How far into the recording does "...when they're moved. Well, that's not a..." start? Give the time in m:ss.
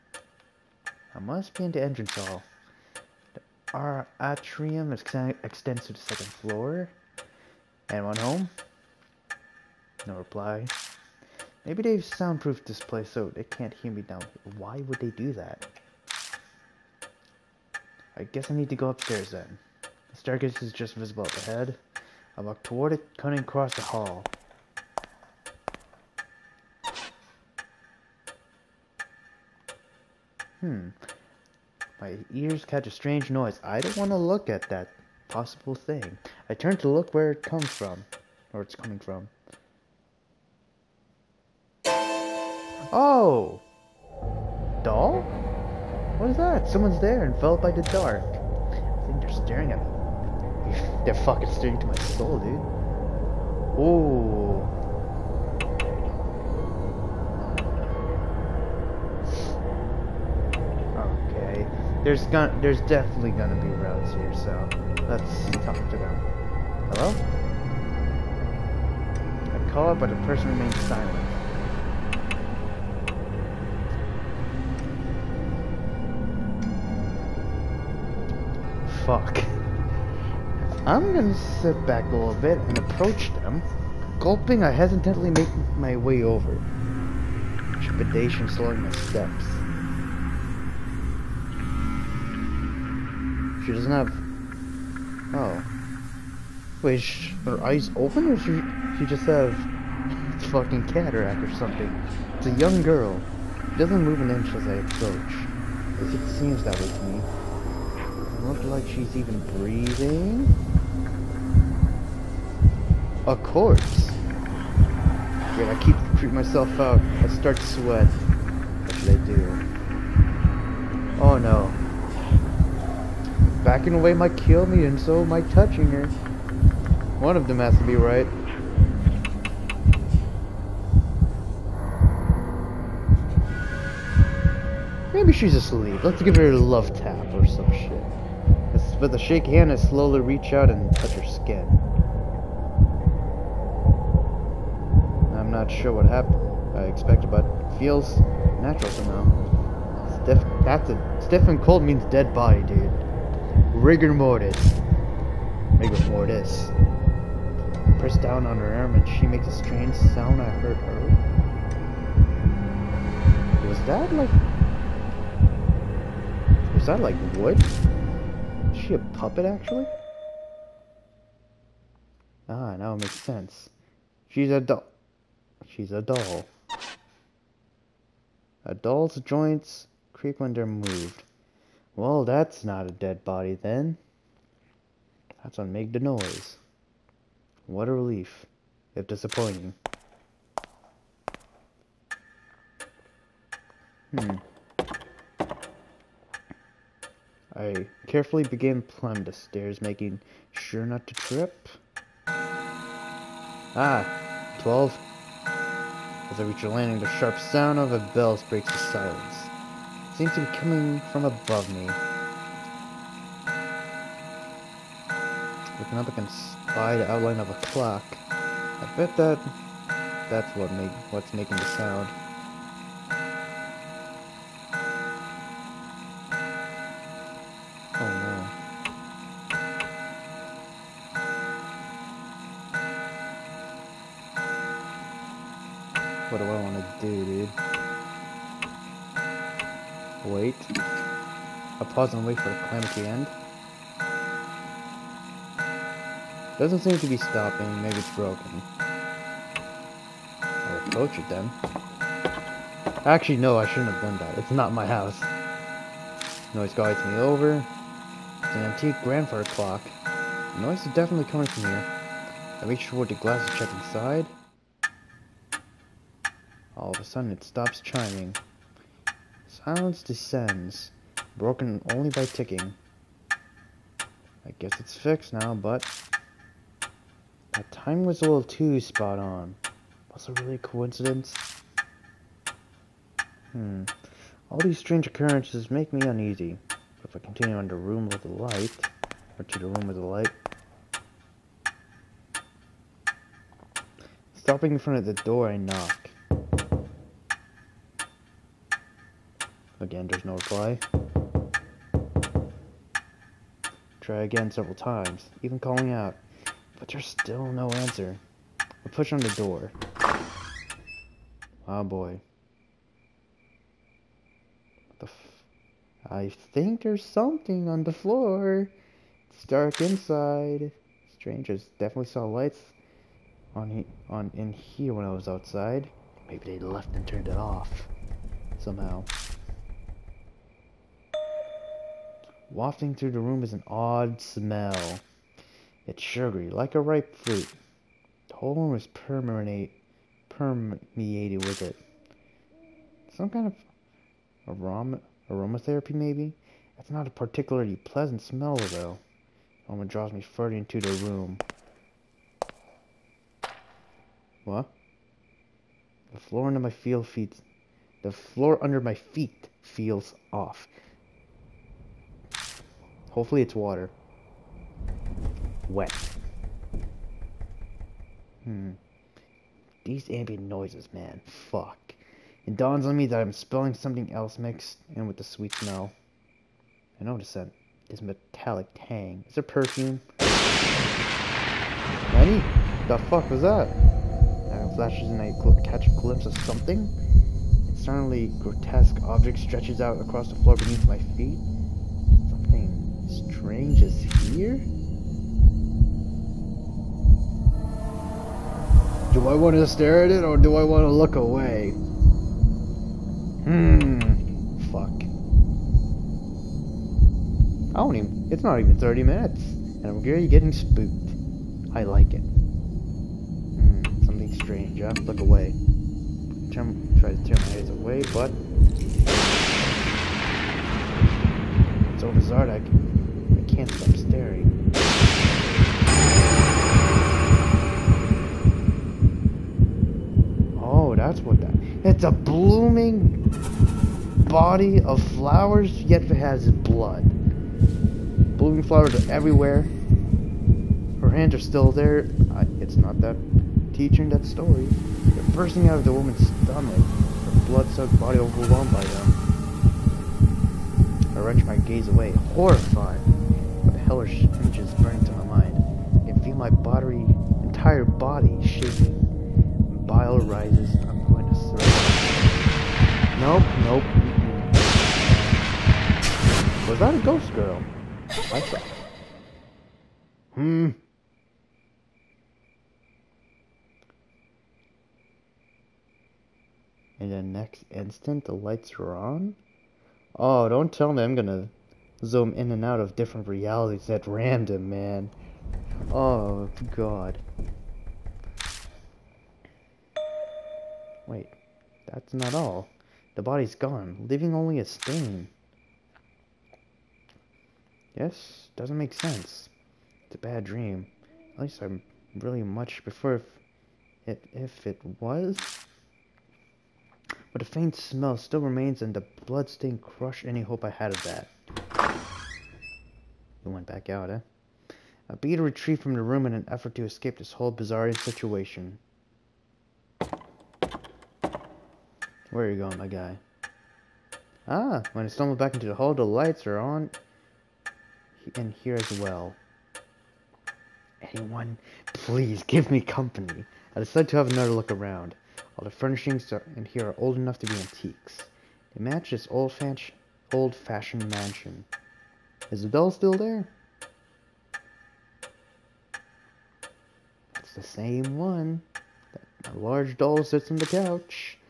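3:00.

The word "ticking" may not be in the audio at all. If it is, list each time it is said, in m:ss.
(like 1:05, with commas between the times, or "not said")
4:32.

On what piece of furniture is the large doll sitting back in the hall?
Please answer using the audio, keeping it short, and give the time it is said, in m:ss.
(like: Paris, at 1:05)
couch, at 9:10.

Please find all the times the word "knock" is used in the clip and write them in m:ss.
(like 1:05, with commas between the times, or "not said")
4:55.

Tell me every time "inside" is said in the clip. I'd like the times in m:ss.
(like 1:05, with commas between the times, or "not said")
4:23, 5:19.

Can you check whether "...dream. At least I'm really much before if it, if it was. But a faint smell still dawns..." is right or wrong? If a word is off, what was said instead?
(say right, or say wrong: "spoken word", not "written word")
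wrong: "remains", not "dawns".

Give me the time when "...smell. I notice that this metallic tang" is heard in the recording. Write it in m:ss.
6:15.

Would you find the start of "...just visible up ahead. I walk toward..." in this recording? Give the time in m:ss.
0:20.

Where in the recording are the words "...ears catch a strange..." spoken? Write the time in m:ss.
0:32.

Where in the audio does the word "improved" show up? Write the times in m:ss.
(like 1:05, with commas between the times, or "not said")
not said.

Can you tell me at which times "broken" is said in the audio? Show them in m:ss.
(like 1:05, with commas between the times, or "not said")
4:08, 4:31.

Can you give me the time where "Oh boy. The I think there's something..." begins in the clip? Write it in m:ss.
5:11.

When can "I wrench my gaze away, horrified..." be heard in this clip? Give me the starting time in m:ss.
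7:31.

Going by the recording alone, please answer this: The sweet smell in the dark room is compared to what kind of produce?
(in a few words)
ripe fruit.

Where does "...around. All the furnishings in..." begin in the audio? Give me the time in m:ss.
8:54.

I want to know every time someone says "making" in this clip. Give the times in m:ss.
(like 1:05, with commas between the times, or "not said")
3:19, 3:41.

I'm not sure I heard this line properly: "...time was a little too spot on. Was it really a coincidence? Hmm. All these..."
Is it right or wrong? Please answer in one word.
right.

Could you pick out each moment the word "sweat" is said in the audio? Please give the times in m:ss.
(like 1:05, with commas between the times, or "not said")
1:57.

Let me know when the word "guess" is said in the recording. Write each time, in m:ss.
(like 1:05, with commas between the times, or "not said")
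0:18, 4:34.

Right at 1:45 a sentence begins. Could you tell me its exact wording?
At least it seems that way to me.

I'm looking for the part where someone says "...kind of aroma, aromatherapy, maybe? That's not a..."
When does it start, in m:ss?
5:43.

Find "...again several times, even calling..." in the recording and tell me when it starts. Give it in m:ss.
5:04.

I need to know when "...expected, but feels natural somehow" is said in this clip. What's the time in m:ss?
2:26.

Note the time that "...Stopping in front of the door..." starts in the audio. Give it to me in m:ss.
4:54.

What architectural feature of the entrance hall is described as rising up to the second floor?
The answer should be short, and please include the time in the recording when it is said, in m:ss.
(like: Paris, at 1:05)
atrium, at 0:04.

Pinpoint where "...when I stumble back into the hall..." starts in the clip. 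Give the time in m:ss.
8:44.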